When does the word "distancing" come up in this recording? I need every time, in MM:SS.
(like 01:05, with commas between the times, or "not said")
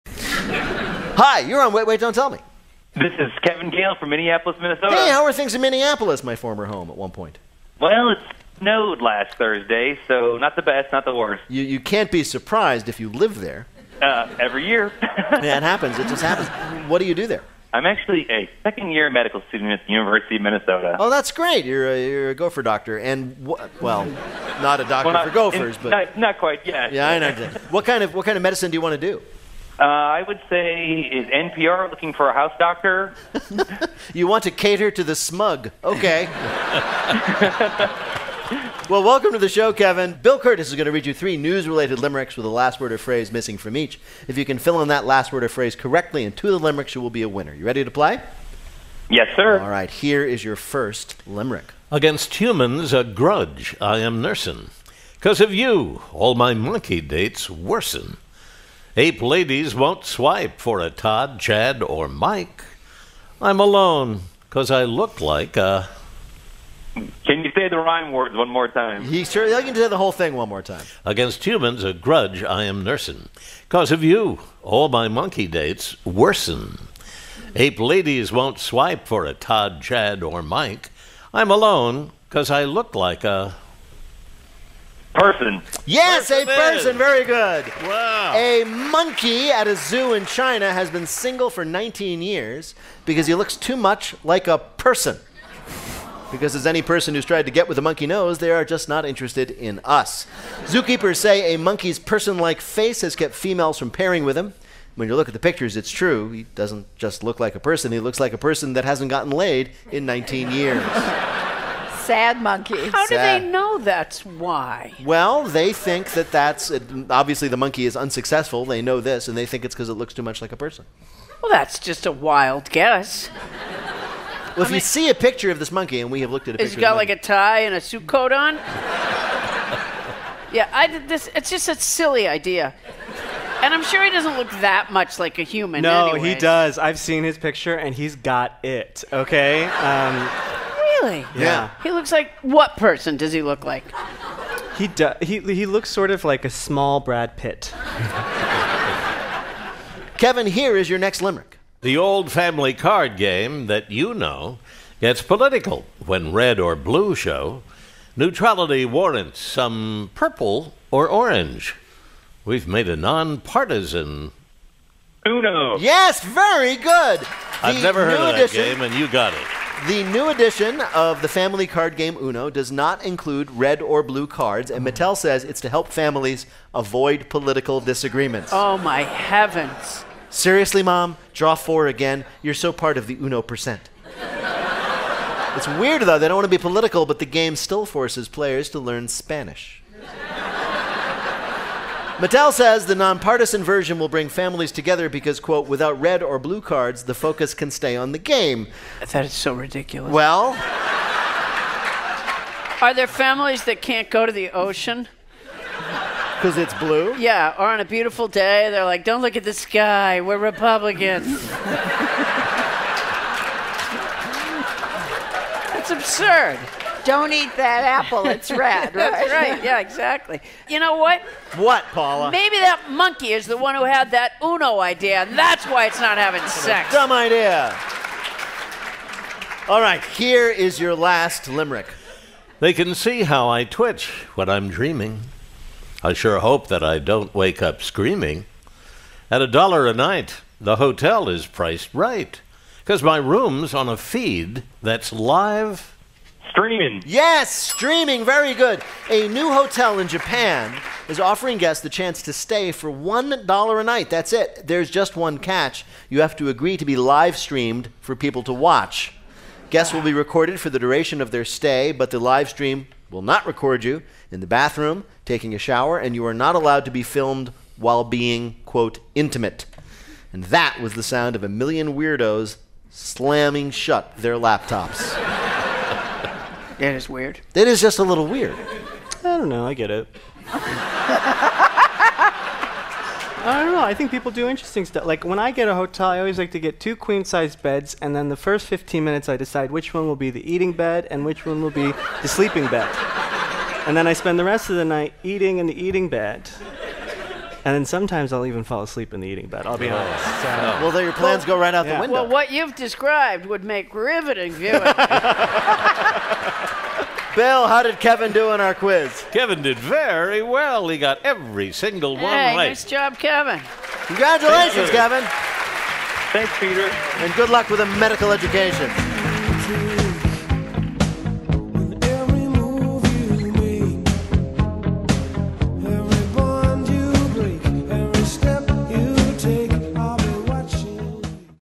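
not said.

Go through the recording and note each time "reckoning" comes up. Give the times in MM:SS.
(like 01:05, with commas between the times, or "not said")
not said.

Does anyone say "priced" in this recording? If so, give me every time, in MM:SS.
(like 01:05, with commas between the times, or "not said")
04:01.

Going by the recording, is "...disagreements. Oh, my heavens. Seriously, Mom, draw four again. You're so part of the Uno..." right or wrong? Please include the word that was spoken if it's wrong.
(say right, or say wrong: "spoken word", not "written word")
right.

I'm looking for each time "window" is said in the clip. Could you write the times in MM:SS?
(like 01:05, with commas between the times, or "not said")
05:02.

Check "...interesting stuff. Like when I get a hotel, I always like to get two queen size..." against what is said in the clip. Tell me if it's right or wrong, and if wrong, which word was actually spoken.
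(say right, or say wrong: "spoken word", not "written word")
right.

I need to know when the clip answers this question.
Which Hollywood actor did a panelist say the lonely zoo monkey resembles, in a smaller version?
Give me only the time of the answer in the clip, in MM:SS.
02:26.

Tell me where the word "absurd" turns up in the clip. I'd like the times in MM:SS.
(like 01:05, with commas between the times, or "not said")
03:35.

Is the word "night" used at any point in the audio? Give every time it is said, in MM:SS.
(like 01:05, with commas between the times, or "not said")
03:59, 04:13, 04:54.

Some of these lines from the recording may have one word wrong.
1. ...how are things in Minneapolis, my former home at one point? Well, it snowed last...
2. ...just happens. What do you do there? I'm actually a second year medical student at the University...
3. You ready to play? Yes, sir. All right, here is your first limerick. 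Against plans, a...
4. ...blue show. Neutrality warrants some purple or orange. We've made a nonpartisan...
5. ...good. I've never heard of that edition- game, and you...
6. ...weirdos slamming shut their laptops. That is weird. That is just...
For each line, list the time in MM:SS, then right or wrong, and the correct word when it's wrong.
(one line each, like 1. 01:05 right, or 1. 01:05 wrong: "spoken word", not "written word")
1. 00:05 right
2. 00:16 right
3. 00:47 wrong: "humans", not "plans"
4. 02:36 right
5. 02:46 right
6. 04:31 right.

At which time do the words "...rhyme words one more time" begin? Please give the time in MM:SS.
01:07.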